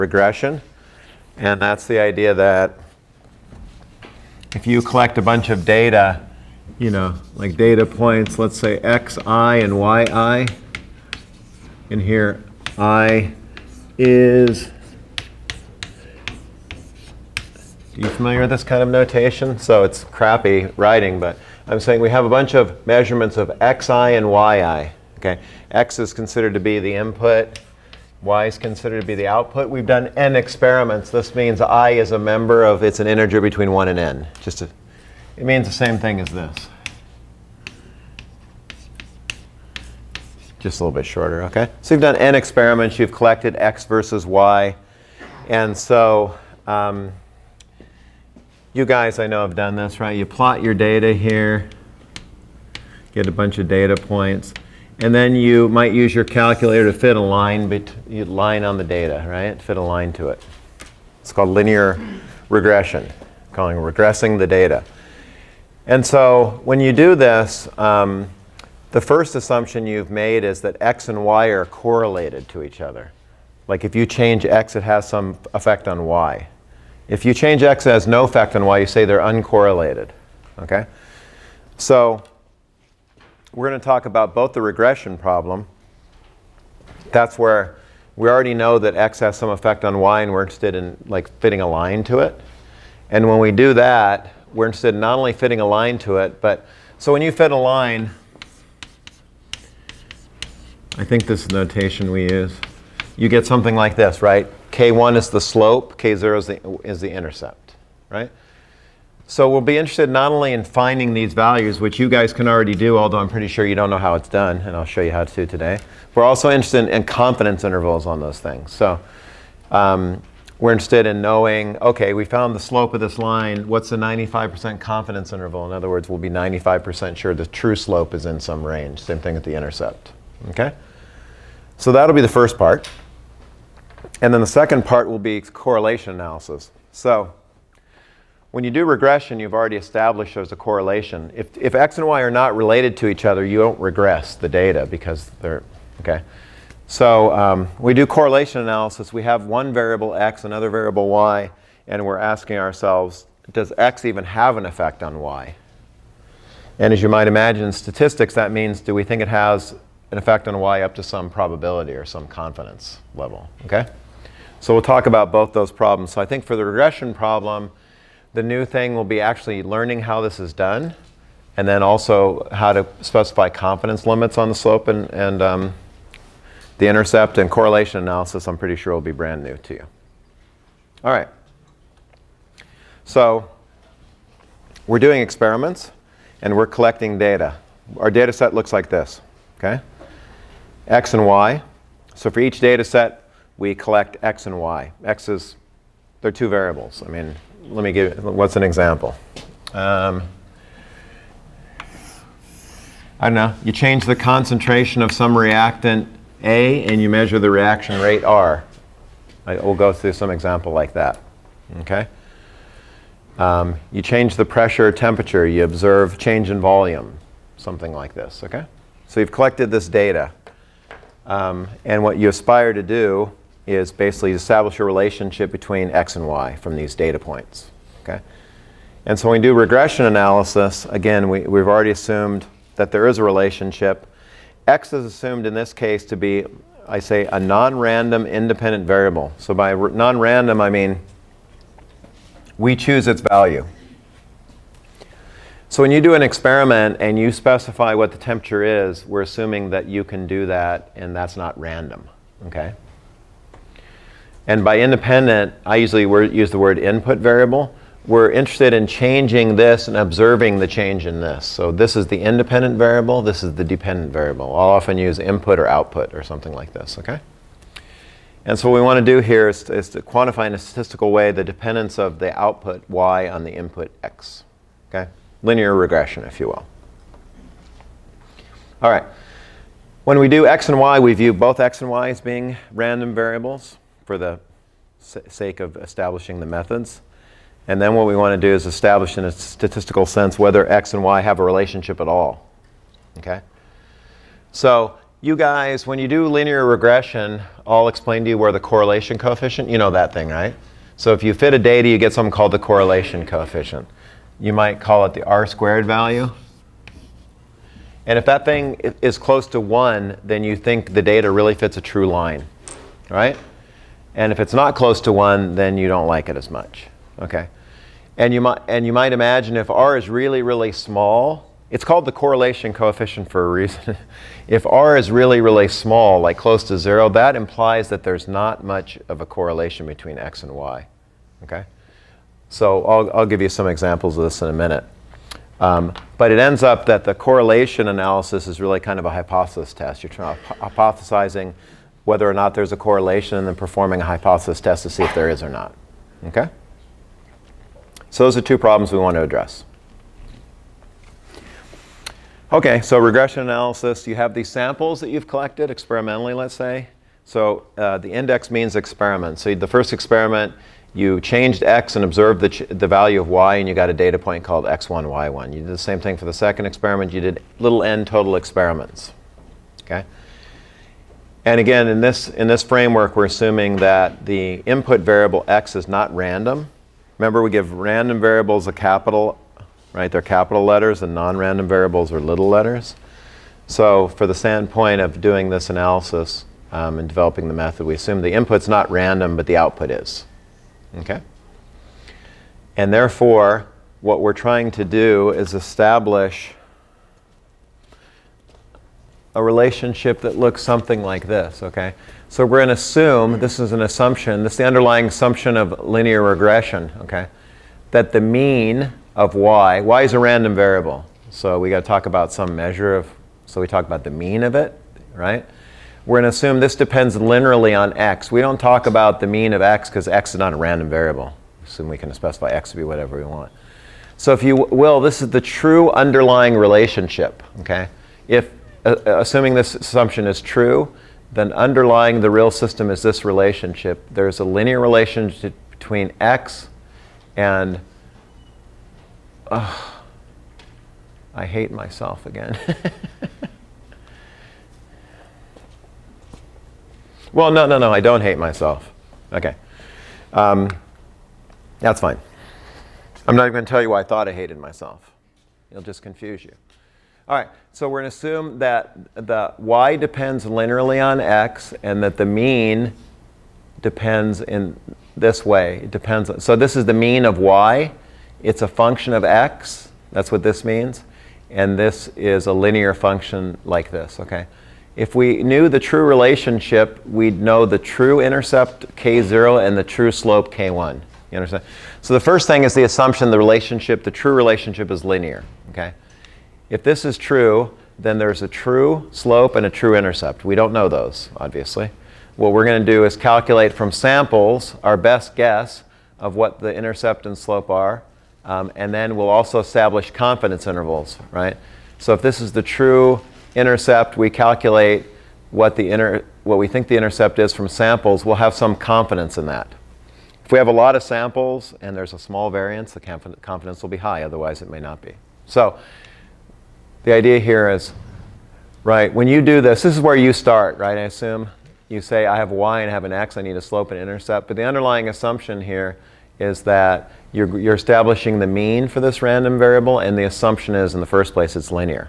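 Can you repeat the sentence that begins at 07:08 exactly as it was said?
If assuming this assumption is true, then underlying the real system is this relationship.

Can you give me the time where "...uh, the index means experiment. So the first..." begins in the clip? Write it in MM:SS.
05:57.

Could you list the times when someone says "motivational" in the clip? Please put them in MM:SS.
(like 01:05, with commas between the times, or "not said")
not said.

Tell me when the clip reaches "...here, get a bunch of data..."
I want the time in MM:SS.
00:51.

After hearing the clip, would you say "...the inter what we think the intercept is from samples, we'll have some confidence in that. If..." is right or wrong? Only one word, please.
right.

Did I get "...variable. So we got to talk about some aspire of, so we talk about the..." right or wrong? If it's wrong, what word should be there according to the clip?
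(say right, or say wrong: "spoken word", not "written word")
wrong: "measure", not "aspire".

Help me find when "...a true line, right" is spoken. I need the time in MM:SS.
05:11.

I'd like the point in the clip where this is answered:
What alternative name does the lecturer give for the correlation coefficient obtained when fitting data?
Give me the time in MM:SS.
05:05.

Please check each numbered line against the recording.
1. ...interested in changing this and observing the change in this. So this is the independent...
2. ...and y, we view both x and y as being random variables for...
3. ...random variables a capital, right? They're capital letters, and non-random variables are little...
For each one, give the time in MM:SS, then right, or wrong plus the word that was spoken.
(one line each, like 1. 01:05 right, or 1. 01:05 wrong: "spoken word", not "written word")
1. 04:18 right
2. 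04:40 right
3. 06:17 right.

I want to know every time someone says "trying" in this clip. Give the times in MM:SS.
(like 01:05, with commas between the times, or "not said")
06:34.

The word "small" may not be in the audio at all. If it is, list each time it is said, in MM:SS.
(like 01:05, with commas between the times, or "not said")
05:20, 05:25, 08:32.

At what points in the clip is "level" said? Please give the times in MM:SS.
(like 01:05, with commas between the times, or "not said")
02:43.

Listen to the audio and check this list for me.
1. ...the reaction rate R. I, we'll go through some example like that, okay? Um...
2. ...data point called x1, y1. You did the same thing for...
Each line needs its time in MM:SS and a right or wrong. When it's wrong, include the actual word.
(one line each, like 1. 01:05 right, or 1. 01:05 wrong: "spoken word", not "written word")
1. 03:27 right
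2. 06:03 right.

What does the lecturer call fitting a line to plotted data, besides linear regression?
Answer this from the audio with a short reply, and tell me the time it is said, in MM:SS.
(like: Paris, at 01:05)
regressing the data, at 01:03.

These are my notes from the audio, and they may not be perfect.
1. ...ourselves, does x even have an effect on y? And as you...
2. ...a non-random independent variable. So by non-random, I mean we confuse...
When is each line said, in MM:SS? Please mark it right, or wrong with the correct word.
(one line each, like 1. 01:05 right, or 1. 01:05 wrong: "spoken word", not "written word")
1. 02:32 right
2. 03:57 wrong: "choose", not "confuse".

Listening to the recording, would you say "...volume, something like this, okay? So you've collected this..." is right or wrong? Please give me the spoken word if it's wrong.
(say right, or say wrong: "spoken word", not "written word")
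right.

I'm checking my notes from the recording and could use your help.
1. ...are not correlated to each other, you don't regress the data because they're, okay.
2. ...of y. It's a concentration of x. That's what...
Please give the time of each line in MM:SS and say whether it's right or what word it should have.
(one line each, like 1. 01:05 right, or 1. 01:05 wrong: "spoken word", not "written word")
1. 02:22 wrong: "related", not "correlated"
2. 07:47 wrong: "function", not "concentration".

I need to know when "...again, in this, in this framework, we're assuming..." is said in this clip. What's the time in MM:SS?
06:11.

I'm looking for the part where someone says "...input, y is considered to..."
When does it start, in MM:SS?
00:26.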